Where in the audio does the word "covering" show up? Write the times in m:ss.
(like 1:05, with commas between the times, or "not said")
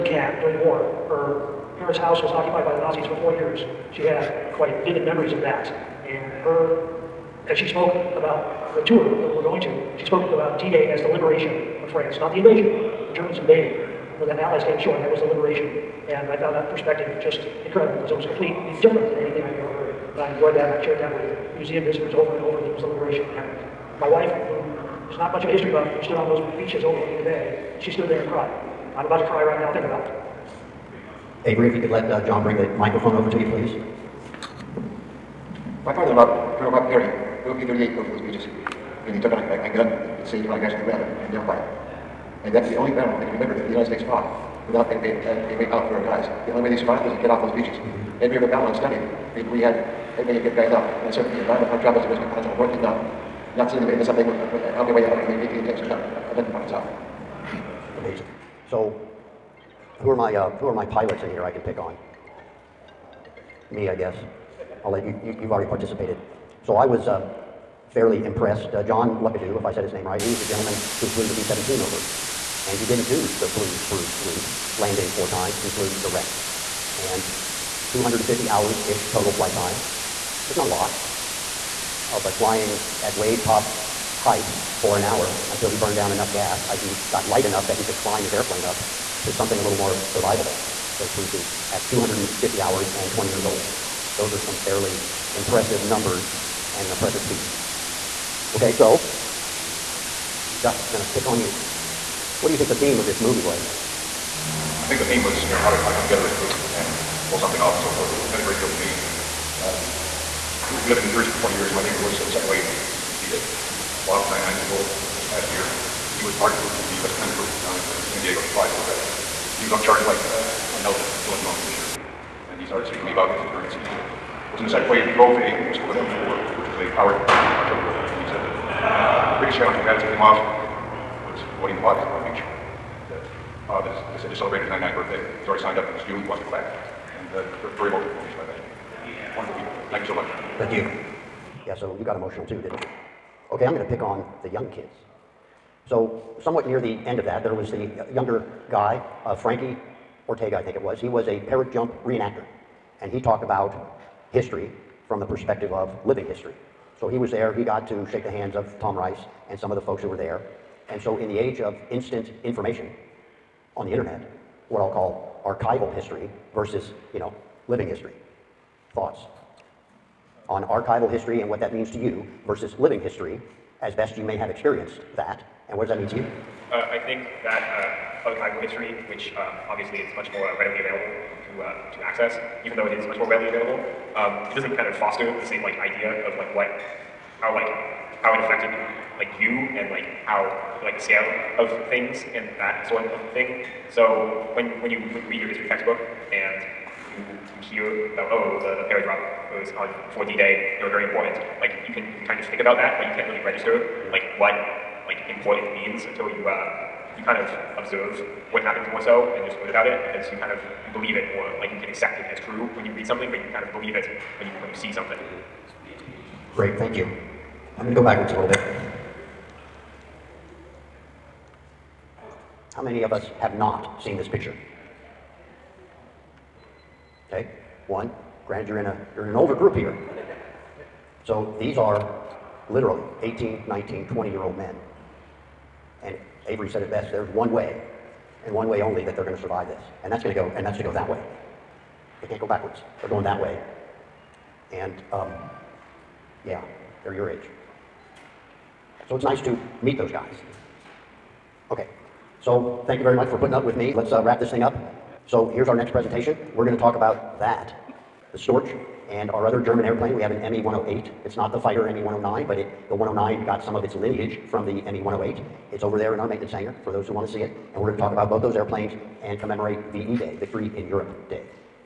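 not said.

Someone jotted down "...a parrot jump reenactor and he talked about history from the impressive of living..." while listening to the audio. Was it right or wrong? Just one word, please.
wrong.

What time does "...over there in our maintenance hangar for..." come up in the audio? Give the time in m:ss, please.
4:25.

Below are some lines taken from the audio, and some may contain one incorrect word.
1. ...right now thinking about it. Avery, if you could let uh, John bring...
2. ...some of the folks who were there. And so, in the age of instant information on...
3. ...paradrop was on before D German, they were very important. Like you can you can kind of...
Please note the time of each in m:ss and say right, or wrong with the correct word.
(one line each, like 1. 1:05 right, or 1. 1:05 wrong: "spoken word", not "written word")
1. 0:29 right
2. 2:39 right
3. 3:18 wrong: "Day", not "German".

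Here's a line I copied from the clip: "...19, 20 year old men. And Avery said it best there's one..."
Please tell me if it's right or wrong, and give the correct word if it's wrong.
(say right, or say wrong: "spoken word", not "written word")
right.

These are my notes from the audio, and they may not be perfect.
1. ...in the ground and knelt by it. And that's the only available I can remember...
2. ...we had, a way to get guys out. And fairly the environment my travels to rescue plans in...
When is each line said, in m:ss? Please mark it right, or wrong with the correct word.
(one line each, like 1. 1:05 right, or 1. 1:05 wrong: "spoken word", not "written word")
1. 0:40 wrong: "battle", not "available"
2. 0:49 wrong: "certainly", not "fairly".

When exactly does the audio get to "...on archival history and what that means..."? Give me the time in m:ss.
2:50.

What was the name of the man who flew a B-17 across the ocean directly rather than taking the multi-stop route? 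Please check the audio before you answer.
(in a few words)
John Luckadoo.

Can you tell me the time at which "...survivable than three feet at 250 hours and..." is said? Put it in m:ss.
1:30.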